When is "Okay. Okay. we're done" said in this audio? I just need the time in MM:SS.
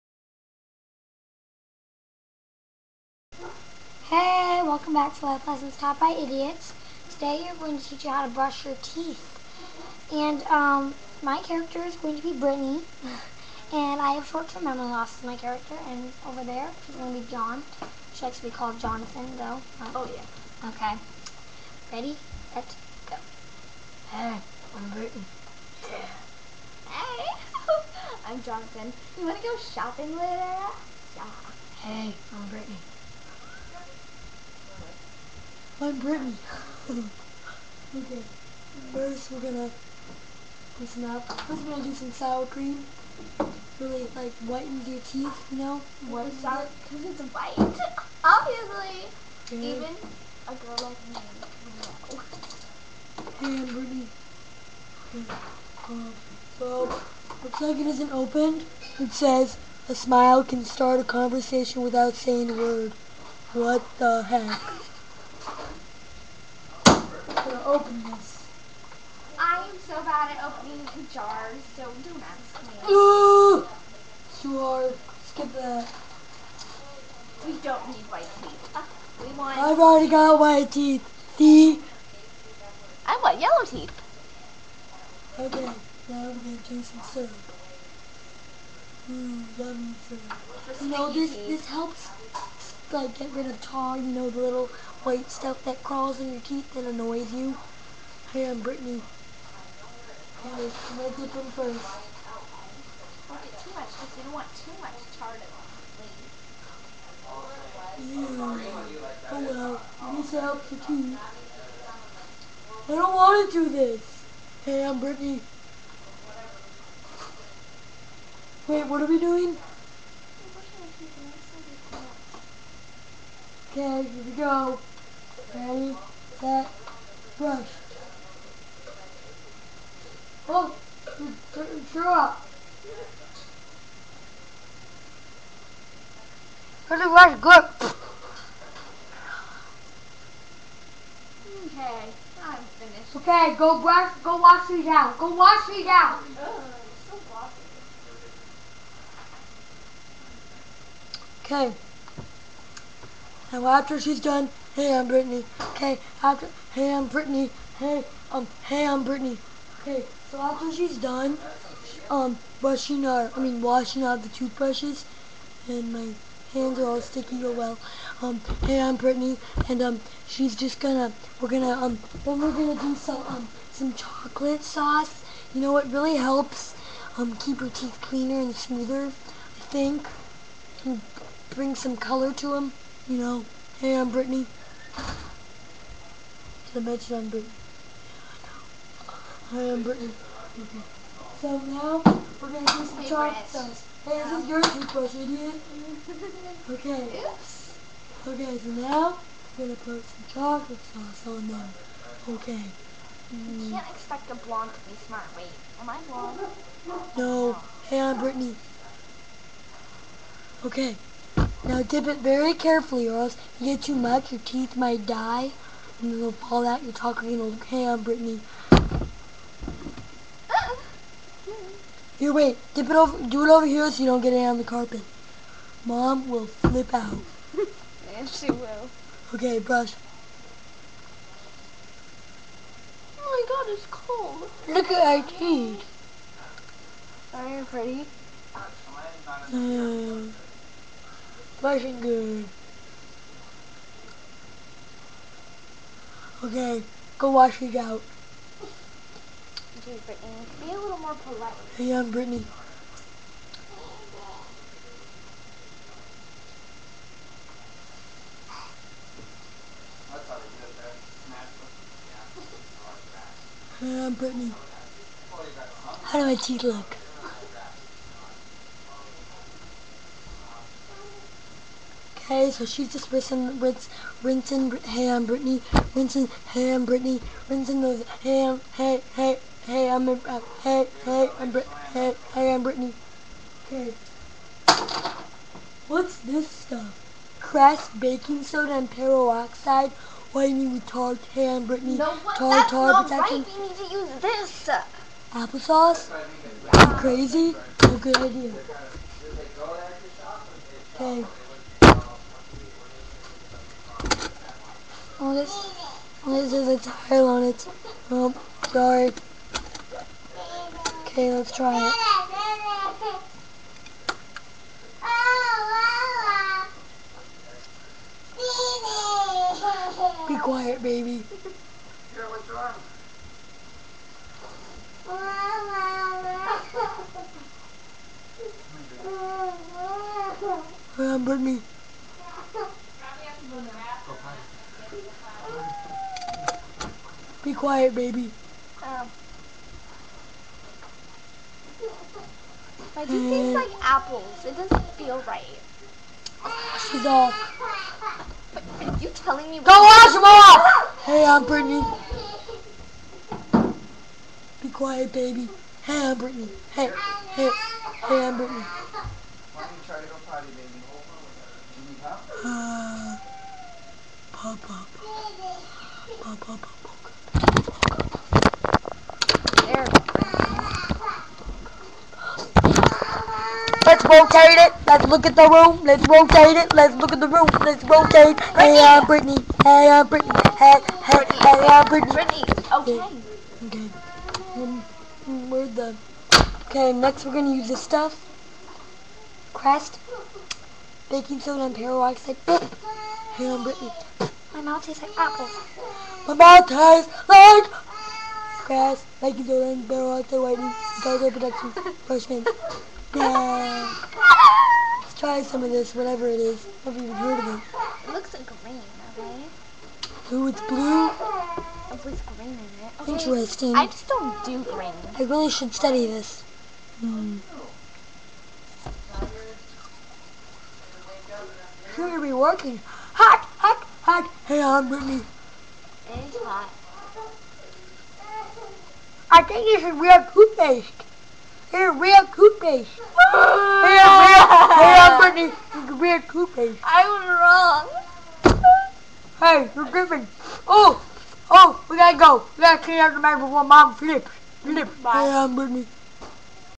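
06:22.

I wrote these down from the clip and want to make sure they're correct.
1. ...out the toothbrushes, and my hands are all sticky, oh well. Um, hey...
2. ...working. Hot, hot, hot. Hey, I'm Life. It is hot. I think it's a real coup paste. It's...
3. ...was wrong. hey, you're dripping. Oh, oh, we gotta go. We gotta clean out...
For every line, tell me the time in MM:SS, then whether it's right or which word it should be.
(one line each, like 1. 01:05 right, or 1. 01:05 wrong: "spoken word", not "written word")
1. 02:44 right
2. 07:02 wrong: "Britney", not "Life"
3. 07:17 right.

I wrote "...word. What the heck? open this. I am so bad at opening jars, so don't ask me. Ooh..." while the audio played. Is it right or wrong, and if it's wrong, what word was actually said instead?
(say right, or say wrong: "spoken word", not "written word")
right.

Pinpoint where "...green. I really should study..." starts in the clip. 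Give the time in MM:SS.
06:54.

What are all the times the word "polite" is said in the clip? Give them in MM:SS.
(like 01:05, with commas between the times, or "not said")
04:11.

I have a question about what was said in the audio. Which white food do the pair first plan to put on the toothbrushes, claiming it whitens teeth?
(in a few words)
Sour cream.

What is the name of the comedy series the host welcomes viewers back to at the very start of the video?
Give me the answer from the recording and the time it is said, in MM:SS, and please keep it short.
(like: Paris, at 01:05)
Life Lessons Taught by Idiots, at 00:05.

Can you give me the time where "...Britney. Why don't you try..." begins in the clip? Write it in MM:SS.
05:58.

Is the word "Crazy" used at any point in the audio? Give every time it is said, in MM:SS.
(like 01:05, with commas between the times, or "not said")
04:56.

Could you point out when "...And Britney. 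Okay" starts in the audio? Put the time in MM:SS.
00:53.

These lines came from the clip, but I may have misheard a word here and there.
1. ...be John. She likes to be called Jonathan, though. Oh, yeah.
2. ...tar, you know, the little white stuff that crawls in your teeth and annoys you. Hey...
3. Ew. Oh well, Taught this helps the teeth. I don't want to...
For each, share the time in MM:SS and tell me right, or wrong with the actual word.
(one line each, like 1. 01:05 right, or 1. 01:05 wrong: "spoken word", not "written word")
1. 00:17 right
2. 01:33 right
3. 01:48 wrong: "Let", not "Taught".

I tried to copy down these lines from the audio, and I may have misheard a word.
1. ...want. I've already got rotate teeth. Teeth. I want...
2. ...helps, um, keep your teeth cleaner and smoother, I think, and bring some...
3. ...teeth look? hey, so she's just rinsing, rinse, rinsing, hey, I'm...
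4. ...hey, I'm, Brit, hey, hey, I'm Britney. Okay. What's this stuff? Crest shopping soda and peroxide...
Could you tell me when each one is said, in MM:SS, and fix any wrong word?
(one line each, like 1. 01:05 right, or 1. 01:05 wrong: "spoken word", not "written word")
1. 01:19 wrong: "white", not "rotate"
2. 02:56 right
3. 04:26 right
4. 04:41 wrong: "baking", not "shopping".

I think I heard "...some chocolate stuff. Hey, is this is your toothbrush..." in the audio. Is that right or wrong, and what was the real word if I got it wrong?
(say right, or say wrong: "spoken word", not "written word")
right.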